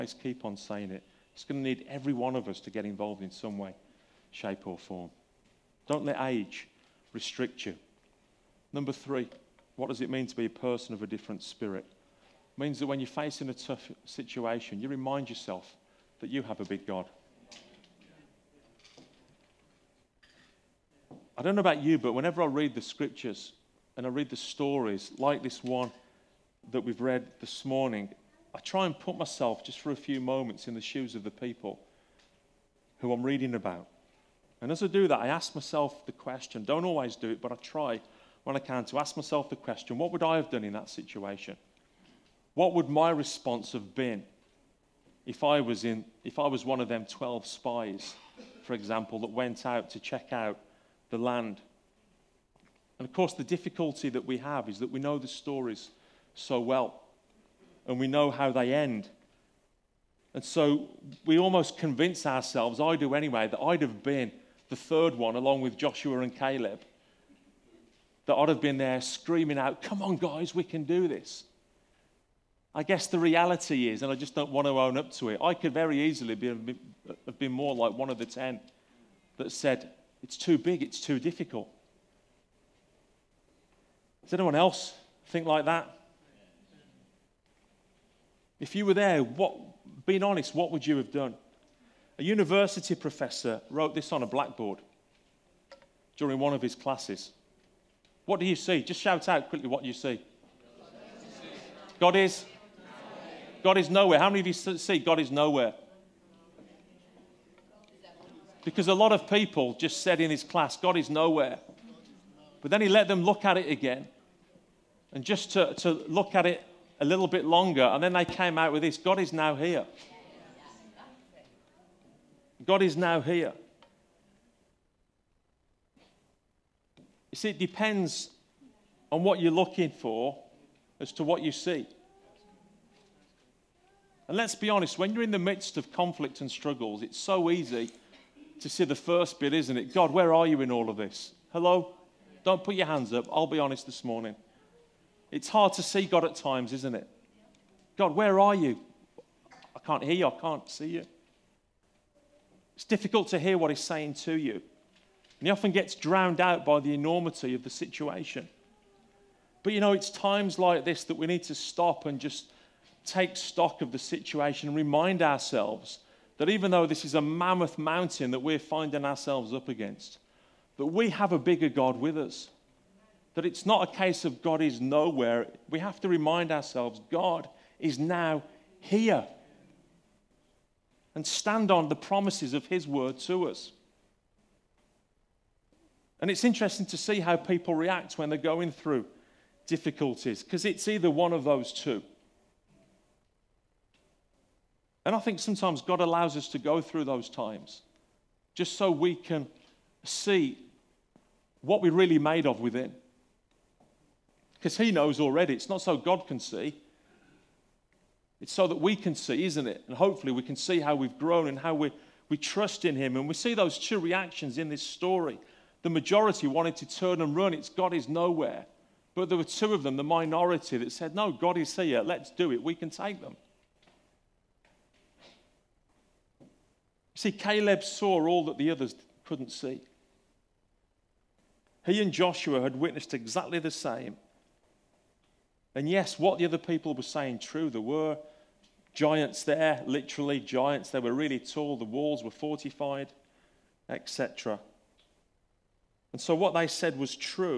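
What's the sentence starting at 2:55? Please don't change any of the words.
We have to remind ourselves God is now here and stand on the promises of His word to us.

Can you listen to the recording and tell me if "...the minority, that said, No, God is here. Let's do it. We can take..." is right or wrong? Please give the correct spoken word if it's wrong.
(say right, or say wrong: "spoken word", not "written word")
right.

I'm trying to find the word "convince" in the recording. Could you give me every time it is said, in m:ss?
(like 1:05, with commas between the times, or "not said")
1:01.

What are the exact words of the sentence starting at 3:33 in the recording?
And we see those two reactions in this story.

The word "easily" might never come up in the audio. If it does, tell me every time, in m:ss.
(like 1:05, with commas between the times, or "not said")
1:16.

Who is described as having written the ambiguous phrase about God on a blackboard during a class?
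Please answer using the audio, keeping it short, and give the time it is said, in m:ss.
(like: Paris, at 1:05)
A university professor, at 1:32.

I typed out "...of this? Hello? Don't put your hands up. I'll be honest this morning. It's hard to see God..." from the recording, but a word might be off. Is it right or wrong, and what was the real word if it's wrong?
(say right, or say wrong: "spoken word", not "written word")
right.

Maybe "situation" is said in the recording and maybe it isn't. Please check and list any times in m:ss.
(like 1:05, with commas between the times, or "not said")
0:14, 0:40, 2:37, 2:43.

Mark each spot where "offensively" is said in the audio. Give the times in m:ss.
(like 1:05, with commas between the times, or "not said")
not said.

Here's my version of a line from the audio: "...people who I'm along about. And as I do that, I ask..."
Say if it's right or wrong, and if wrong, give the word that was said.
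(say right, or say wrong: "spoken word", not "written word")
wrong: "reading", not "along".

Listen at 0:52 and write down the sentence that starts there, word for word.
And of course, the difficulty that we have is that we know the stories so well.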